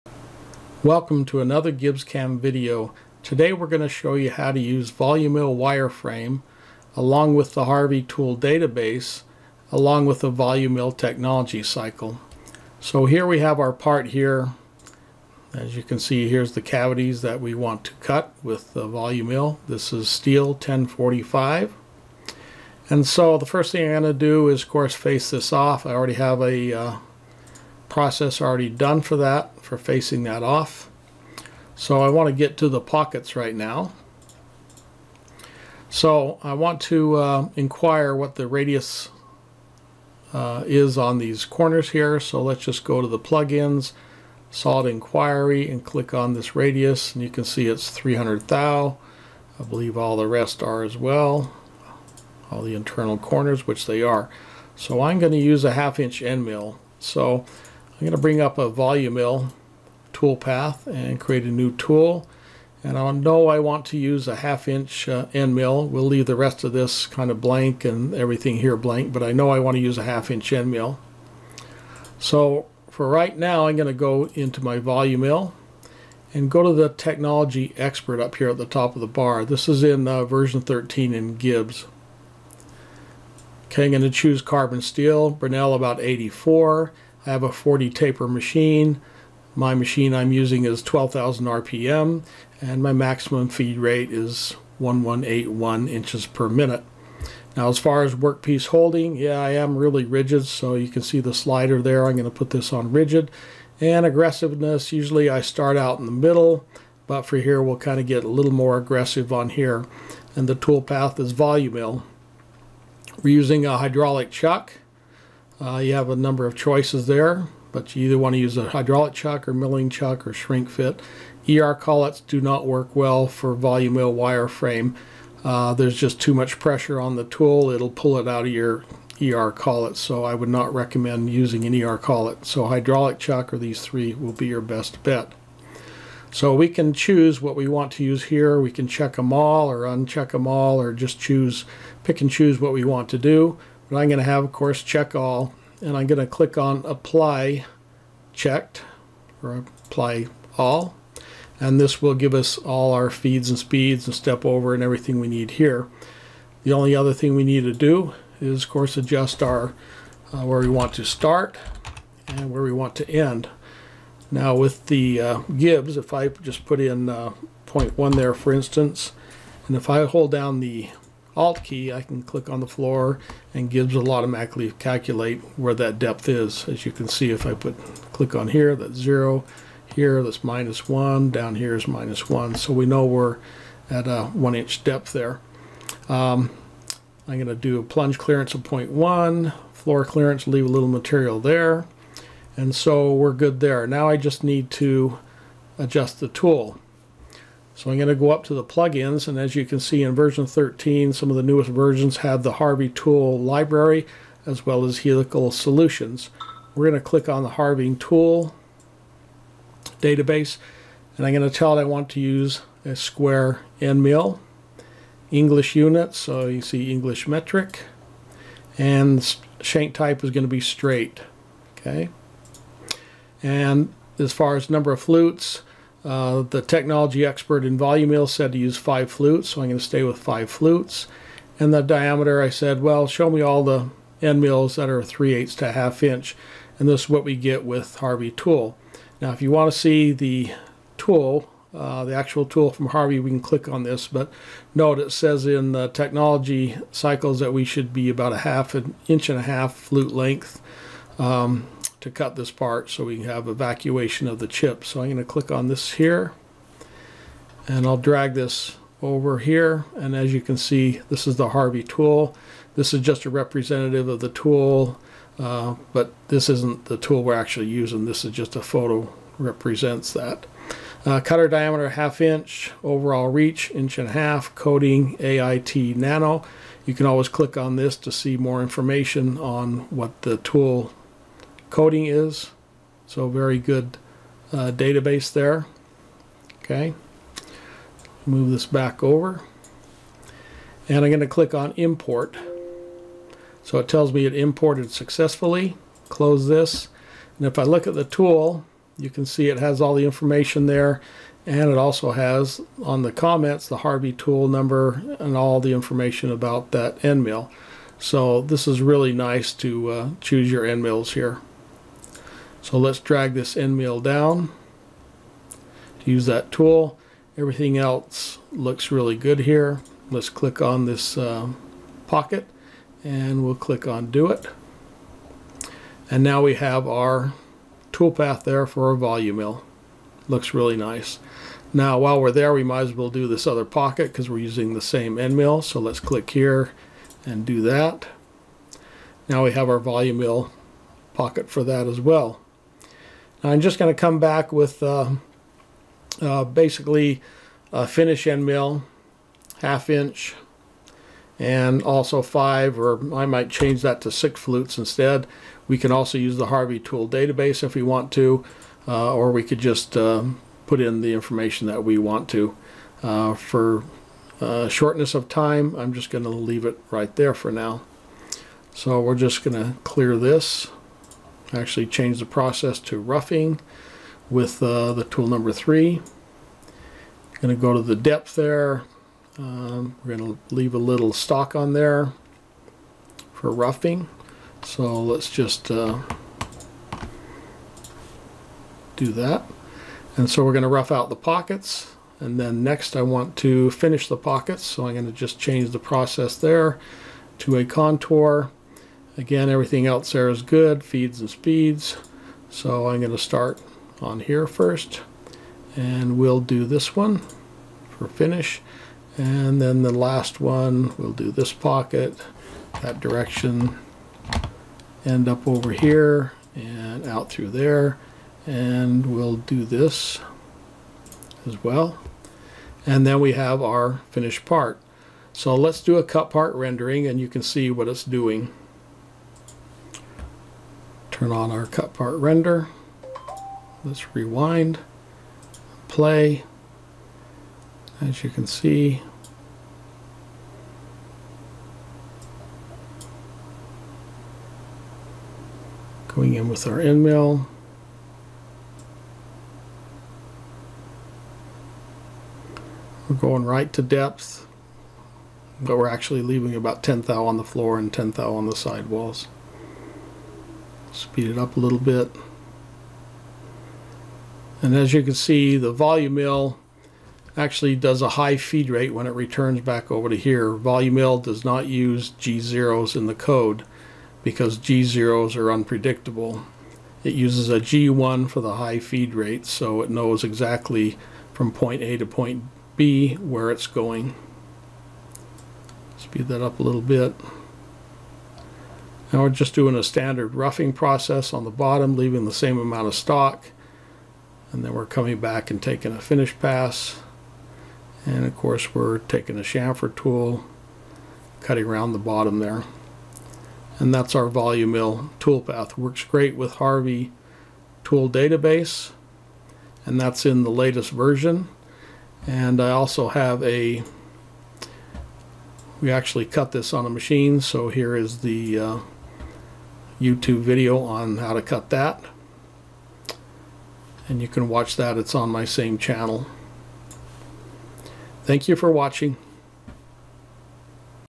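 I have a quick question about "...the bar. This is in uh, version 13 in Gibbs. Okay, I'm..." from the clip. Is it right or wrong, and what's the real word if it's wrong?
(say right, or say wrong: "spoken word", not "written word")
right.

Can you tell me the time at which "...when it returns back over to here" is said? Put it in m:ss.
7:48.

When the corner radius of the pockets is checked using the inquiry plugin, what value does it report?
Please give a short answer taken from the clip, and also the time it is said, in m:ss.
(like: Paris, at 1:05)
300 thou, at 0:47.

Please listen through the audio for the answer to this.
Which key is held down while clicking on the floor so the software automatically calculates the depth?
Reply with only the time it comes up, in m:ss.
2:51.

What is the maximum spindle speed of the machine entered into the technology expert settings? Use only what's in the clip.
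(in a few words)
12,000 RPM.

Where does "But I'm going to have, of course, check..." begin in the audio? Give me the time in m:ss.
2:23.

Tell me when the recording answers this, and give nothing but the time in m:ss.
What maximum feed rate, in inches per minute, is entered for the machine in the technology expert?
1:34.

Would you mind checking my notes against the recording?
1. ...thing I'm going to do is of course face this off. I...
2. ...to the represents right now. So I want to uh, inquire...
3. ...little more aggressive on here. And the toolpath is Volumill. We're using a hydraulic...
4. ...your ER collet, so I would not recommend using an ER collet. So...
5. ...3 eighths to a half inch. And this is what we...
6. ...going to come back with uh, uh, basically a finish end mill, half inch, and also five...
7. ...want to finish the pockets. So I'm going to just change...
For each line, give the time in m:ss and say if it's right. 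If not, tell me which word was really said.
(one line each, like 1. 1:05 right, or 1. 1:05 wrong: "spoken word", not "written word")
1. 0:23 right
2. 0:32 wrong: "pockets", not "represents"
3. 1:48 right
4. 2:08 right
5. 3:55 right
6. 5:43 right
7. 6:33 right.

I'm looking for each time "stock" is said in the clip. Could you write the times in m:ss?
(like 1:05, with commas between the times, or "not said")
6:21, 8:12.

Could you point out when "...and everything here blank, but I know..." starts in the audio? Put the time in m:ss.
1:07.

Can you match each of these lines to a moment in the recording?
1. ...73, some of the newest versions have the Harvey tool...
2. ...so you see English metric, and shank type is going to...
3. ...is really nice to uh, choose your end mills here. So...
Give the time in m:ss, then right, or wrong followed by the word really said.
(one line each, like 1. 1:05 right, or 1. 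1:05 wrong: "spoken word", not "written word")
1. 3:20 wrong: "13", not "73"
2. 3:36 right
3. 5:08 right.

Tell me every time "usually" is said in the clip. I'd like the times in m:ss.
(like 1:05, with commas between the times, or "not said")
1:44.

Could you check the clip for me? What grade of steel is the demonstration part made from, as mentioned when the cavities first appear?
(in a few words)
1045.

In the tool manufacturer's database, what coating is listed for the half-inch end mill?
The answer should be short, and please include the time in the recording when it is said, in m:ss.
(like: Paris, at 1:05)
AIT nano, at 4:35.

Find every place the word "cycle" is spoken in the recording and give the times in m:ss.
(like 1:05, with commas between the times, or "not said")
0:11, 4:06.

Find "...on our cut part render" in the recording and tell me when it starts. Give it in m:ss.
7:11.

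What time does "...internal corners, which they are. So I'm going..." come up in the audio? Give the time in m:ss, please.
0:52.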